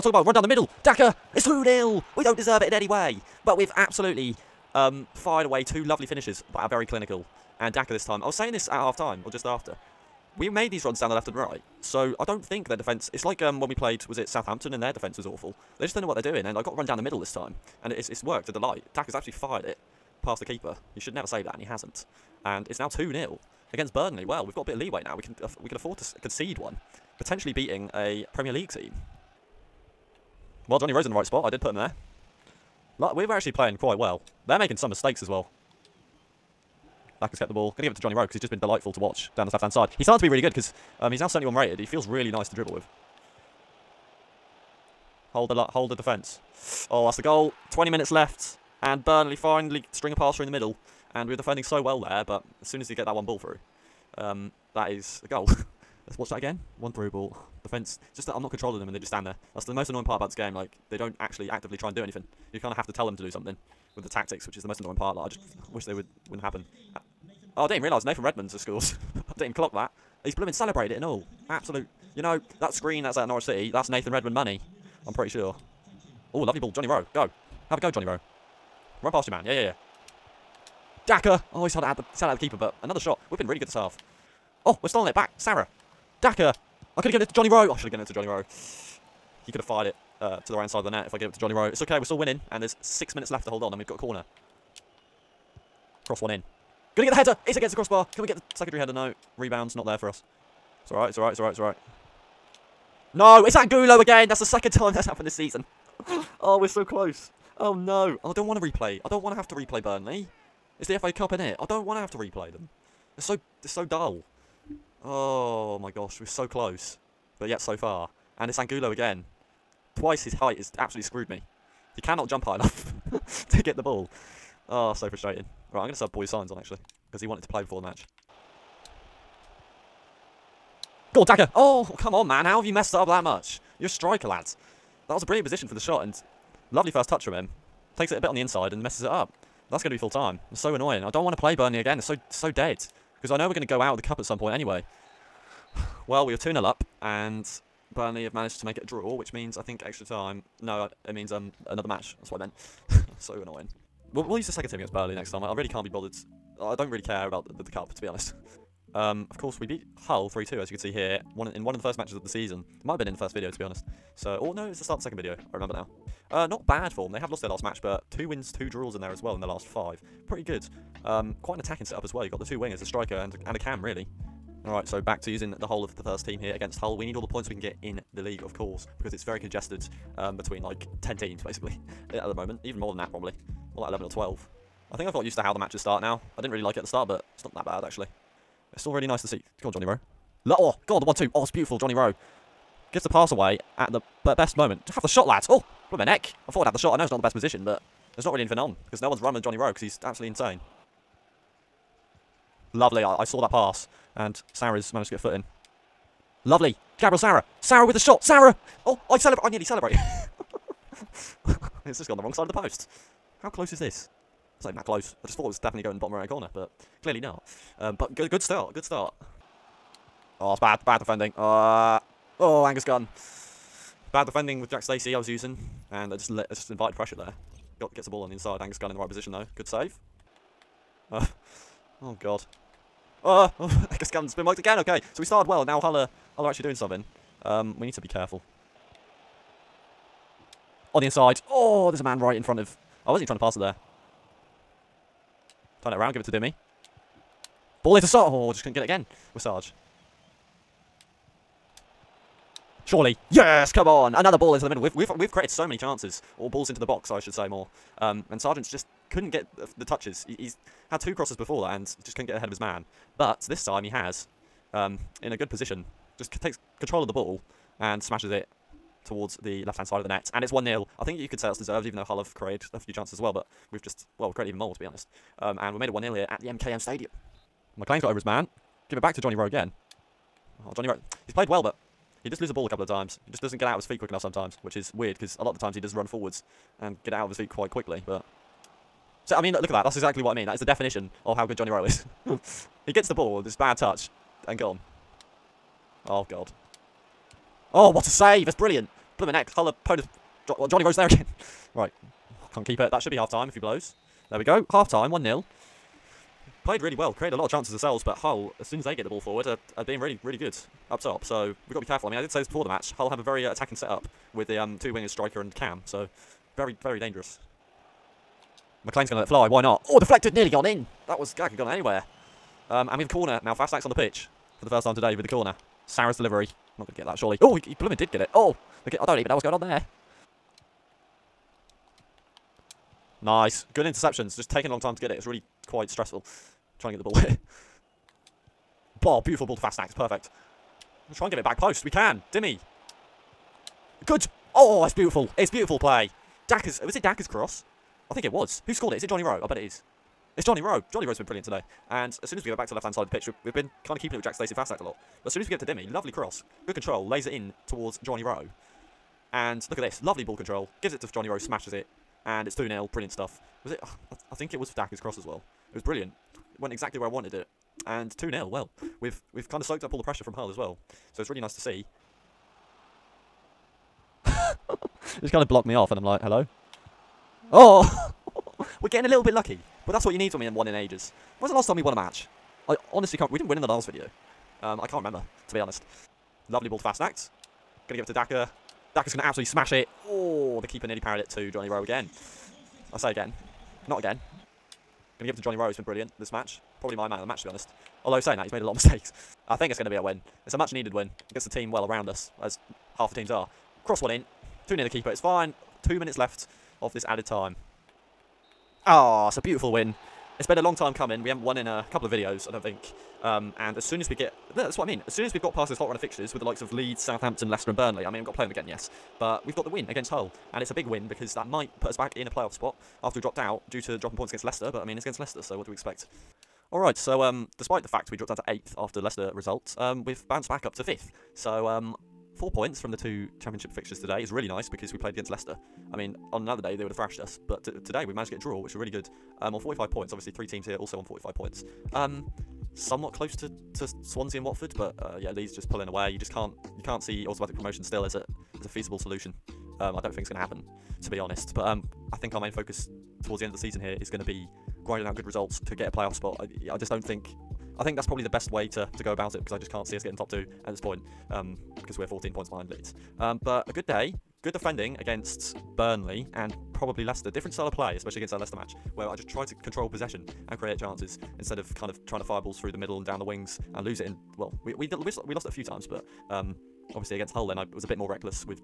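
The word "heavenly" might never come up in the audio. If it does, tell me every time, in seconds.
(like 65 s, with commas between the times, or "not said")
not said.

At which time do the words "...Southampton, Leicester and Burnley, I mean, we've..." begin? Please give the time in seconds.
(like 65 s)
417 s.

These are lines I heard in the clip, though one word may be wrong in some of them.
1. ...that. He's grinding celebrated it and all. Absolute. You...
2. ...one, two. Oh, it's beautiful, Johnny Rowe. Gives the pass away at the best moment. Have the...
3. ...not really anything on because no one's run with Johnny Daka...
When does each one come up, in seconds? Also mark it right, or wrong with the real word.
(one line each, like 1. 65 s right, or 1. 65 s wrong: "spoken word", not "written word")
1. 69 s wrong: "blooming", not "grinding"
2. 191 s right
3. 198 s wrong: "Rowe", not "Daka".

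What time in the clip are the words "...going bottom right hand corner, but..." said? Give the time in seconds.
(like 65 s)
215 s.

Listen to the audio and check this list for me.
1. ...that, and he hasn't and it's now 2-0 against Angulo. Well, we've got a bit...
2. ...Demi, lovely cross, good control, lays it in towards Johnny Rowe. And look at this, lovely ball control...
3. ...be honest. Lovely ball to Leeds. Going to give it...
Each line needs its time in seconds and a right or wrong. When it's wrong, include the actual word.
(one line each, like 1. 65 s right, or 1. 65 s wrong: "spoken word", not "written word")
1. 21 s wrong: "Burnley", not "Angulo"
2. 355 s right
3. 385 s wrong: "Fassnacht", not "Leeds".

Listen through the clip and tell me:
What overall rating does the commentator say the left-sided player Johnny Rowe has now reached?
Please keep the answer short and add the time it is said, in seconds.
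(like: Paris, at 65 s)
71, at 41 s.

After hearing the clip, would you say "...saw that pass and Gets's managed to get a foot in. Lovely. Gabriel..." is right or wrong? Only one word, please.
wrong.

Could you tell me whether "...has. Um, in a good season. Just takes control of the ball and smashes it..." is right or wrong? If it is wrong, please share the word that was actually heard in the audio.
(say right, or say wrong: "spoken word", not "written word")
wrong: "position", not "season".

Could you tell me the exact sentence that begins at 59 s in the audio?
That's the most annoying part about this game.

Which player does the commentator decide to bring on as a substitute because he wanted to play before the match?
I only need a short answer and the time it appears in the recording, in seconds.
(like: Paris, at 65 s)
Borja Sainz, at 126 s.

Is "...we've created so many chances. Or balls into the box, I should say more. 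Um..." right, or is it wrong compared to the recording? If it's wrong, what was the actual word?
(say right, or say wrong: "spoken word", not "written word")
right.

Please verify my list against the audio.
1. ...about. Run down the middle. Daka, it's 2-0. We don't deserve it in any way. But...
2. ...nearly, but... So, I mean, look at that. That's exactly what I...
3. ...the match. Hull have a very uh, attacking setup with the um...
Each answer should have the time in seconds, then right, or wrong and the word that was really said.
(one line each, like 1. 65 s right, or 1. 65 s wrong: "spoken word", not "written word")
1. 0 s right
2. 287 s wrong: "quickly", not "nearly"
3. 312 s right.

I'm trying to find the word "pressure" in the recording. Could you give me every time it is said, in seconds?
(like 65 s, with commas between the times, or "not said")
226 s, 370 s.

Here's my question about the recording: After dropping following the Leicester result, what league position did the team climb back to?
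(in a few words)
5th.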